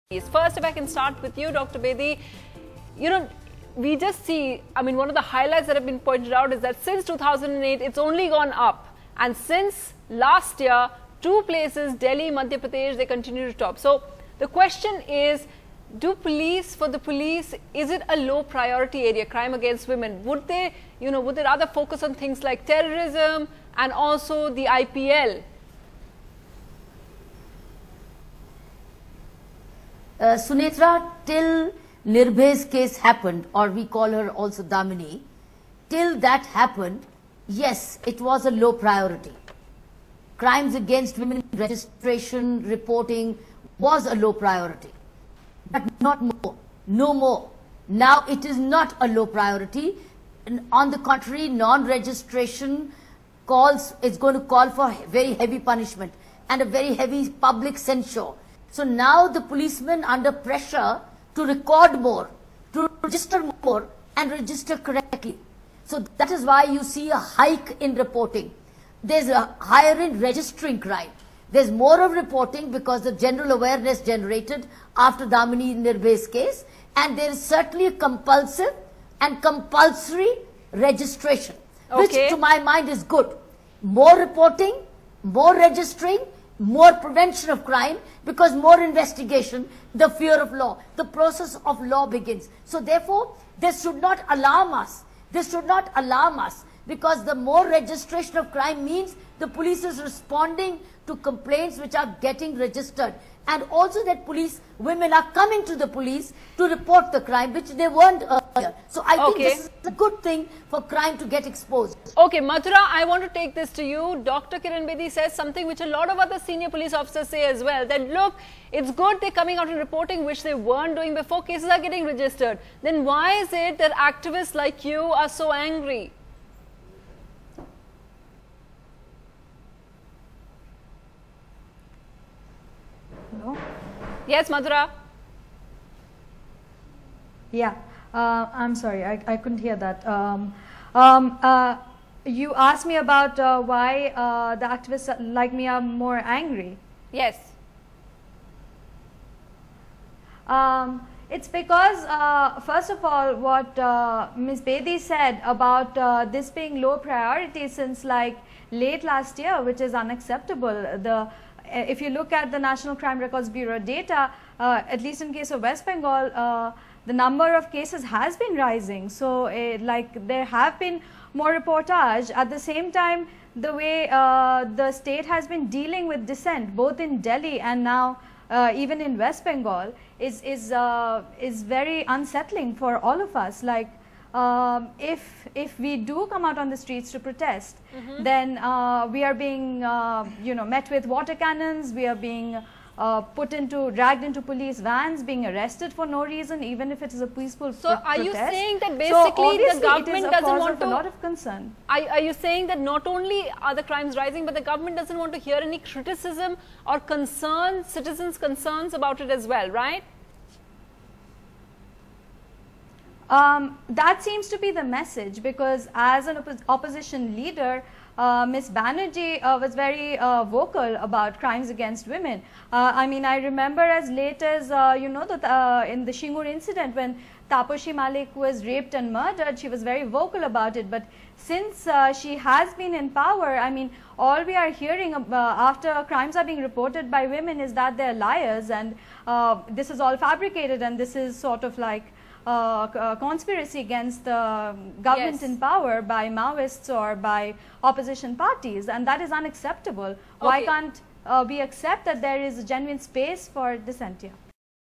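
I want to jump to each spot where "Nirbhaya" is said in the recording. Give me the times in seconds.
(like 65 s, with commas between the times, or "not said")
32 s, 75 s.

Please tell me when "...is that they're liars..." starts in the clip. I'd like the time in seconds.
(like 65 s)
237 s.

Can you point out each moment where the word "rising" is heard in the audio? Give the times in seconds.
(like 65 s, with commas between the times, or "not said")
168 s, 204 s.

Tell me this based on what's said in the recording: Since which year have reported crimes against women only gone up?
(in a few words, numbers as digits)
2008.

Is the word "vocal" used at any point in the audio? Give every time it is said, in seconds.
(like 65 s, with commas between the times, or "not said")
220 s, 230 s.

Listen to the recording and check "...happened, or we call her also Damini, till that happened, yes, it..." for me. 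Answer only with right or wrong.
right.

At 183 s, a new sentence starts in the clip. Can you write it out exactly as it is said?
Like um, if if we do come out on the streets to protest, mm -hmm.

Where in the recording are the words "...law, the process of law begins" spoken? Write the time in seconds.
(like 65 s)
90 s.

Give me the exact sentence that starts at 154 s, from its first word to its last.
Bedi said about this being low priority since like late last year, which is unacceptable.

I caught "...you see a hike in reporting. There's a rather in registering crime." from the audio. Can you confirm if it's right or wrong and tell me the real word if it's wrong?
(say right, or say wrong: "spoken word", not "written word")
wrong: "higher", not "rather".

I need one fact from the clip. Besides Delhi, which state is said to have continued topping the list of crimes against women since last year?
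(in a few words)
Madhya Pradesh.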